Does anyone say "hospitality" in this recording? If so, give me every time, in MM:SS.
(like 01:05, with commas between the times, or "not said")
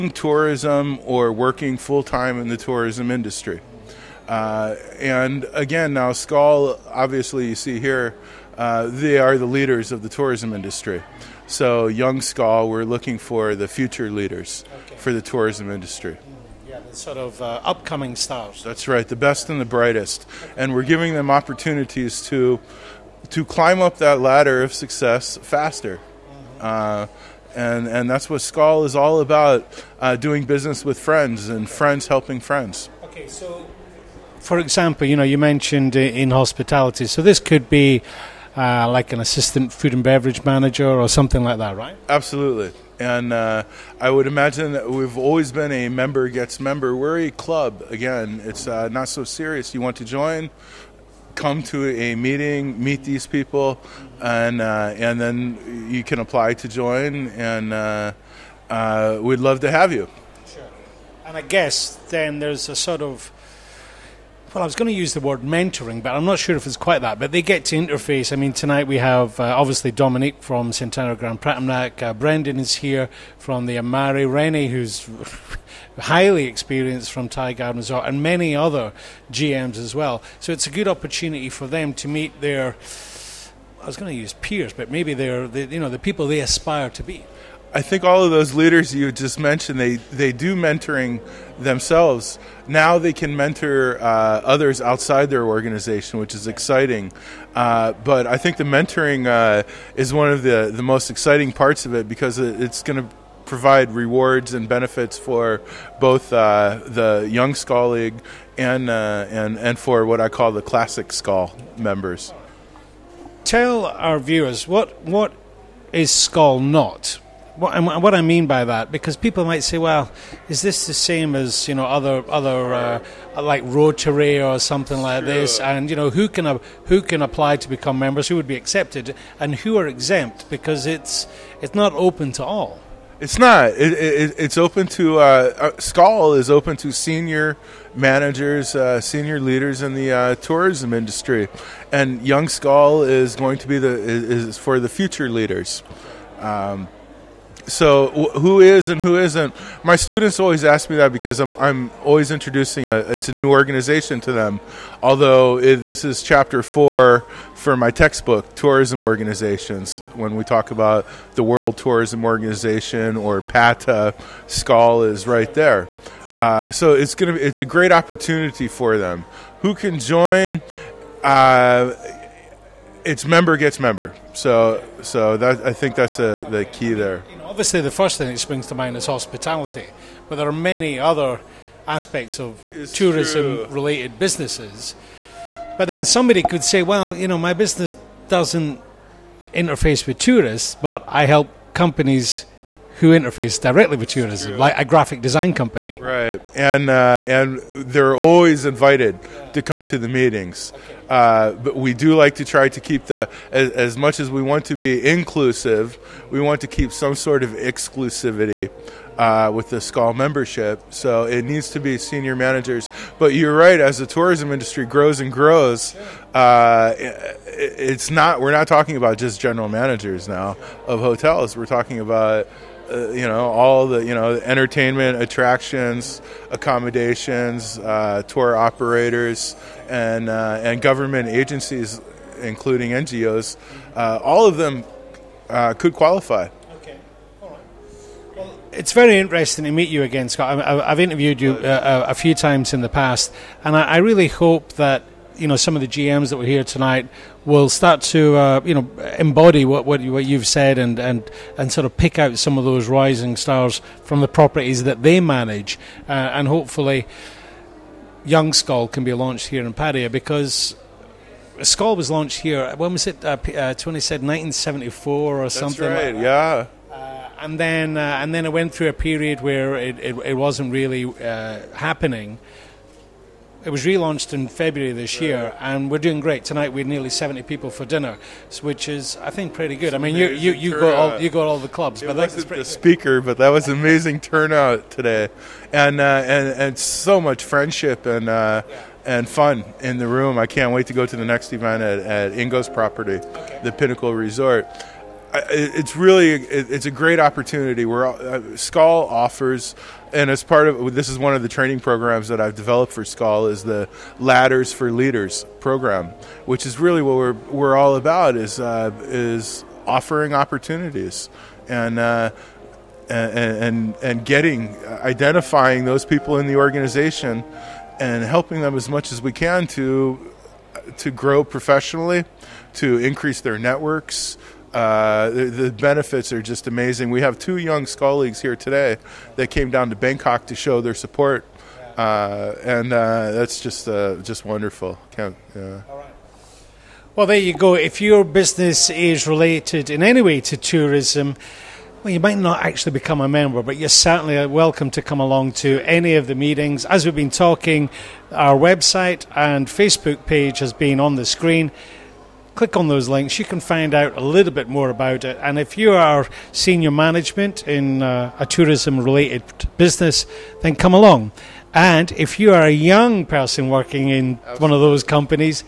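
00:36, 02:59.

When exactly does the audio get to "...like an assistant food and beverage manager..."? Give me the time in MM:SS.
00:38.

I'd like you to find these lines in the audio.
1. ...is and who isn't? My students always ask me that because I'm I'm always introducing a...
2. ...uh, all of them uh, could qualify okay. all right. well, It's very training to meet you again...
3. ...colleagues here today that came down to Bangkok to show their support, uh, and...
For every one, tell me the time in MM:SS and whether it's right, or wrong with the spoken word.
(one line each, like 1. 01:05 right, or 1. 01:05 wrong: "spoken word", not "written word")
1. 02:28 right
2. 03:53 wrong: "interesting", not "training"
3. 05:27 right.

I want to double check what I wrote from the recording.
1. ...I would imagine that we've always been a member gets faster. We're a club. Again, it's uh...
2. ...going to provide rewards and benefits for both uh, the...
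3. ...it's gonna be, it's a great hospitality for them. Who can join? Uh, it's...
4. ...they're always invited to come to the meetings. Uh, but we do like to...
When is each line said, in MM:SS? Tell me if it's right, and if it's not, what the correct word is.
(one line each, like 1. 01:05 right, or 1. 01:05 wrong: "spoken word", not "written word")
1. 00:44 wrong: "member", not "faster"
2. 01:42 right
3. 02:46 wrong: "opportunity", not "hospitality"
4. 03:17 right.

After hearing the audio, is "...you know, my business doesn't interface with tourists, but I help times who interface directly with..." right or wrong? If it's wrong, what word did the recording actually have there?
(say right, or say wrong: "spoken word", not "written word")
wrong: "companies", not "times".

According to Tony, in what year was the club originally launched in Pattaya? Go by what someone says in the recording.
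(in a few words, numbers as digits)
1974.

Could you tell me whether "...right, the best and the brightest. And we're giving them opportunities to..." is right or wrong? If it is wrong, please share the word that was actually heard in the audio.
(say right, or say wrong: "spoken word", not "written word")
right.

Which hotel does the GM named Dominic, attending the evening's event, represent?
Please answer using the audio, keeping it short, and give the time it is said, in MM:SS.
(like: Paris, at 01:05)
Centara Grand Phratamnak, at 01:10.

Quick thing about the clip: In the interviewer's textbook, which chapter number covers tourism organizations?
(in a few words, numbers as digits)
4.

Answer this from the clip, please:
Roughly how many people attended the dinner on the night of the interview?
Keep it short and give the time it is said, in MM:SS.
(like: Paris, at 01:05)
70, at 04:36.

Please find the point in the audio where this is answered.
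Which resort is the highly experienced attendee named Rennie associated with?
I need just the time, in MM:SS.
01:17.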